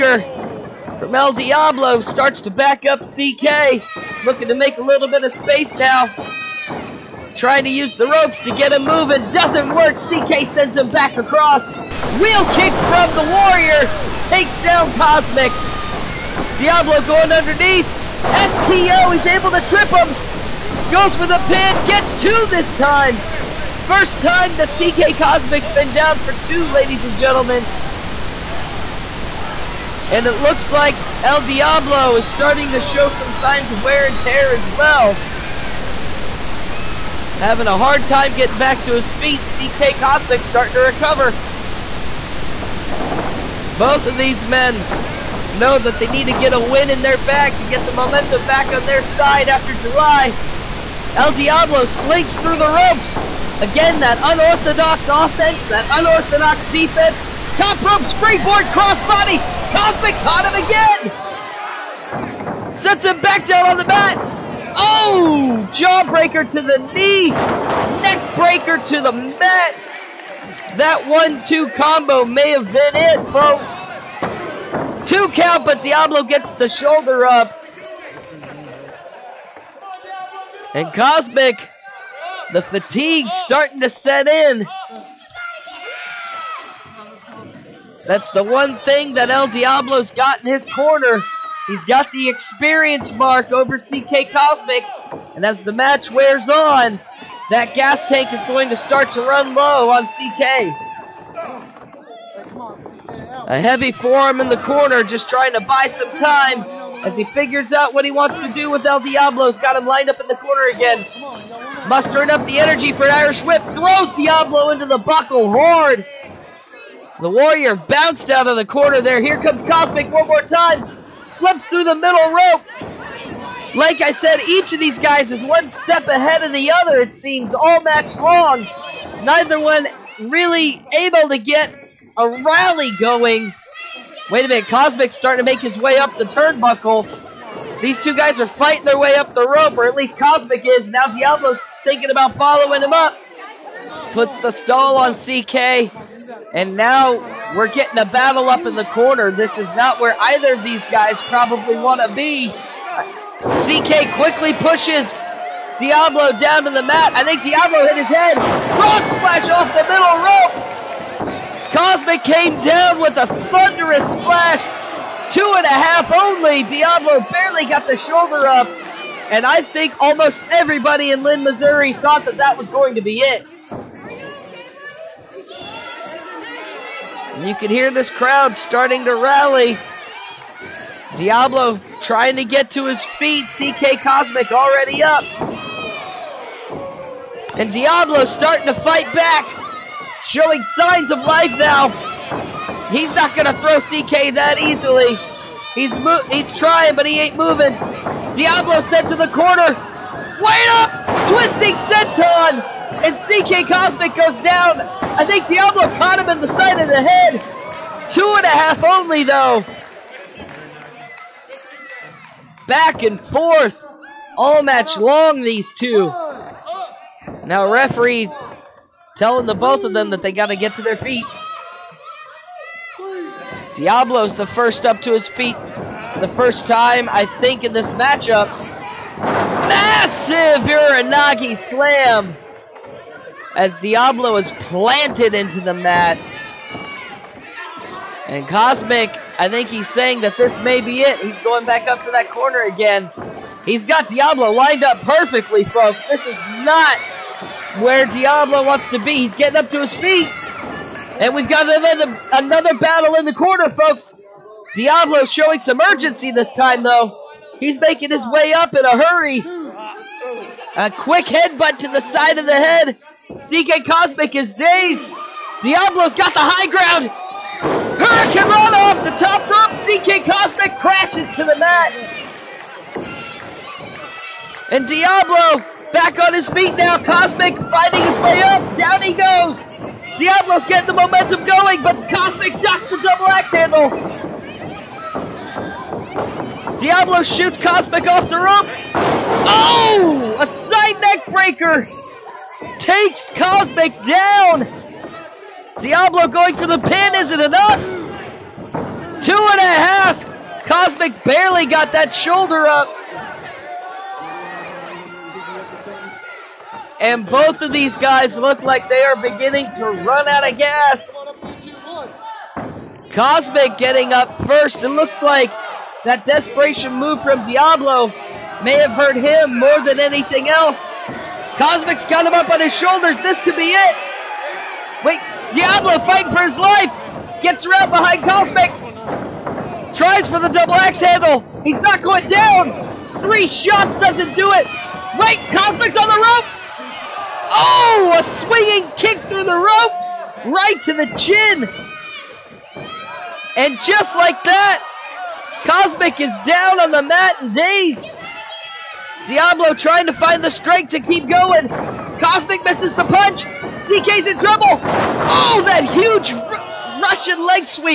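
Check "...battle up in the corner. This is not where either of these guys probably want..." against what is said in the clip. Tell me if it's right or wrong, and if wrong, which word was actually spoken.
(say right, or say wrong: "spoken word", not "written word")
right.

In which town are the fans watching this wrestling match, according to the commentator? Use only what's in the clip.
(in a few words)
Linn, Missouri.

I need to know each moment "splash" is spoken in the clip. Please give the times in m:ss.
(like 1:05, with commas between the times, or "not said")
2:39, 2:44.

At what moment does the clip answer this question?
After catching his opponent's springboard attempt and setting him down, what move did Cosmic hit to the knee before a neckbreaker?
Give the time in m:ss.
1:05.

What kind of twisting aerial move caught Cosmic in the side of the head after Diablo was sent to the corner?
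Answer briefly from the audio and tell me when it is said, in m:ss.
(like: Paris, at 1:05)
Twisting senton, at 3:21.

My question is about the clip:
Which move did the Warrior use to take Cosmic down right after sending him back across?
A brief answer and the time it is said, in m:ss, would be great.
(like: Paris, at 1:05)
Wheel kick, at 0:12.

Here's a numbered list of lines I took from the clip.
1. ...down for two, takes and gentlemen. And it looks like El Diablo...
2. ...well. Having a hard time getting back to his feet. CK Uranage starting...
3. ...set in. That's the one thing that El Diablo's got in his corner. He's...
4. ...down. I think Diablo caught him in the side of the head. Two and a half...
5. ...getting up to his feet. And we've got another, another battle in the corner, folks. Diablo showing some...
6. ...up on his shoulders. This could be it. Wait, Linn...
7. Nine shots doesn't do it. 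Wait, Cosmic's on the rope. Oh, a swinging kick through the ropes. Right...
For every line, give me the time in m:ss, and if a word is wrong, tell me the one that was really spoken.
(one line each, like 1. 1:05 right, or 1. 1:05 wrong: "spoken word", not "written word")
1. 0:25 wrong: "ladies", not "takes"
2. 0:34 wrong: "Cosmic", not "Uranage"
3. 1:23 right
4. 3:24 right
5. 4:09 right
6. 5:22 wrong: "Diablo", not "Linn"
7. 5:33 wrong: "Three", not "Nine".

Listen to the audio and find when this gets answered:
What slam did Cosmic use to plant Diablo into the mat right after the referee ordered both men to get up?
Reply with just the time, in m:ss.
3:50.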